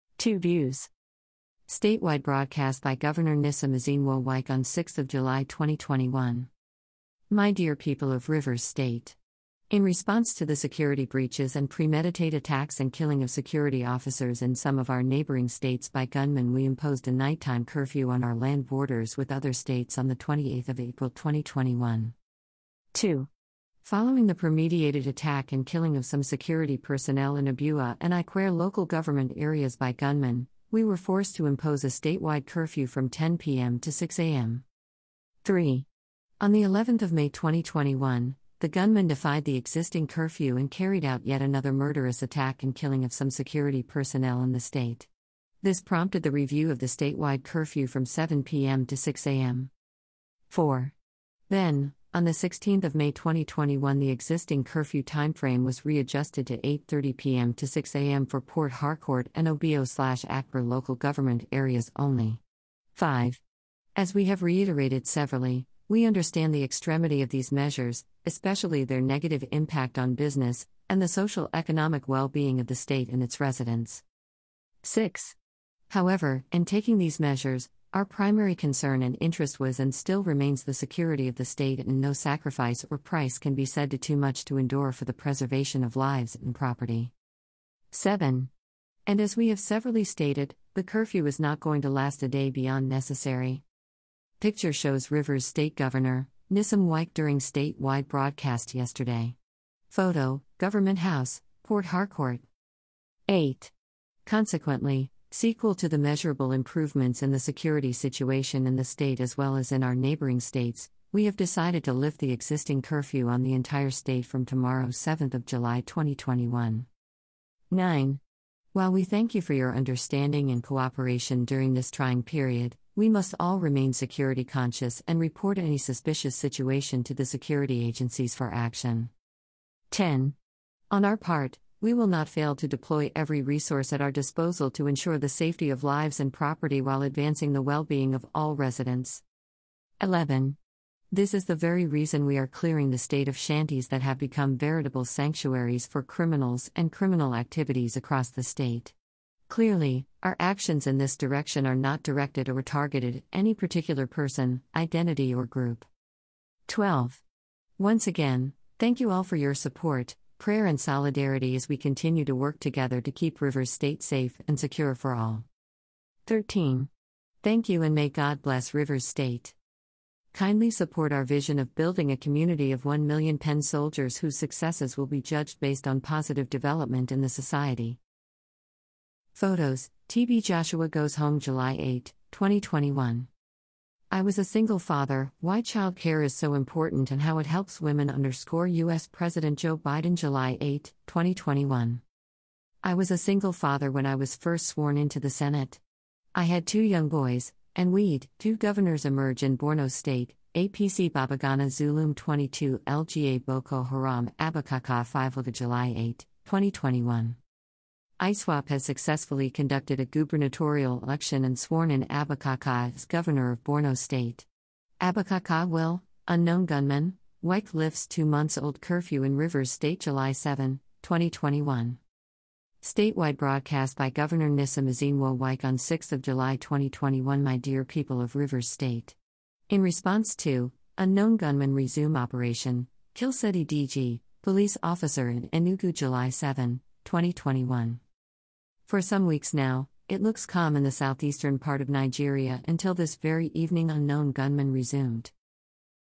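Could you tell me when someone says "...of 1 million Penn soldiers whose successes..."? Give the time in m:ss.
2:52.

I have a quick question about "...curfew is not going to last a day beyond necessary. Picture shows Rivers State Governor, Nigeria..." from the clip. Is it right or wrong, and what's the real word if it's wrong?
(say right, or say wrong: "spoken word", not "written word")
wrong: "Nyesom", not "Nigeria".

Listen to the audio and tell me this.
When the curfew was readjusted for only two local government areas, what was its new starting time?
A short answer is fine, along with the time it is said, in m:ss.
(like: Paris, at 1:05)
8:30 p.m., at 0:56.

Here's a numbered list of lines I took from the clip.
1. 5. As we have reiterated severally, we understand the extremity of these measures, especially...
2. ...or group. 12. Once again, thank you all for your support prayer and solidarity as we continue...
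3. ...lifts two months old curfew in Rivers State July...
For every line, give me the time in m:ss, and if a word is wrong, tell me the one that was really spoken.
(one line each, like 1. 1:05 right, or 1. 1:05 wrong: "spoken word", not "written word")
1. 1:02 right
2. 2:35 right
3. 3:37 right.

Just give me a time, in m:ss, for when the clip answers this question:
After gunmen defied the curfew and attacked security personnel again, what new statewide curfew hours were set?
0:48.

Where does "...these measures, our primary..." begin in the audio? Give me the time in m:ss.
1:16.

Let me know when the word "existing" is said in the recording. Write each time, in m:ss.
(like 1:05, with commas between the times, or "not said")
0:39, 0:54, 1:52.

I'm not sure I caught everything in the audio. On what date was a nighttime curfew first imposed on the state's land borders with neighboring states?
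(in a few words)
28 April 2021.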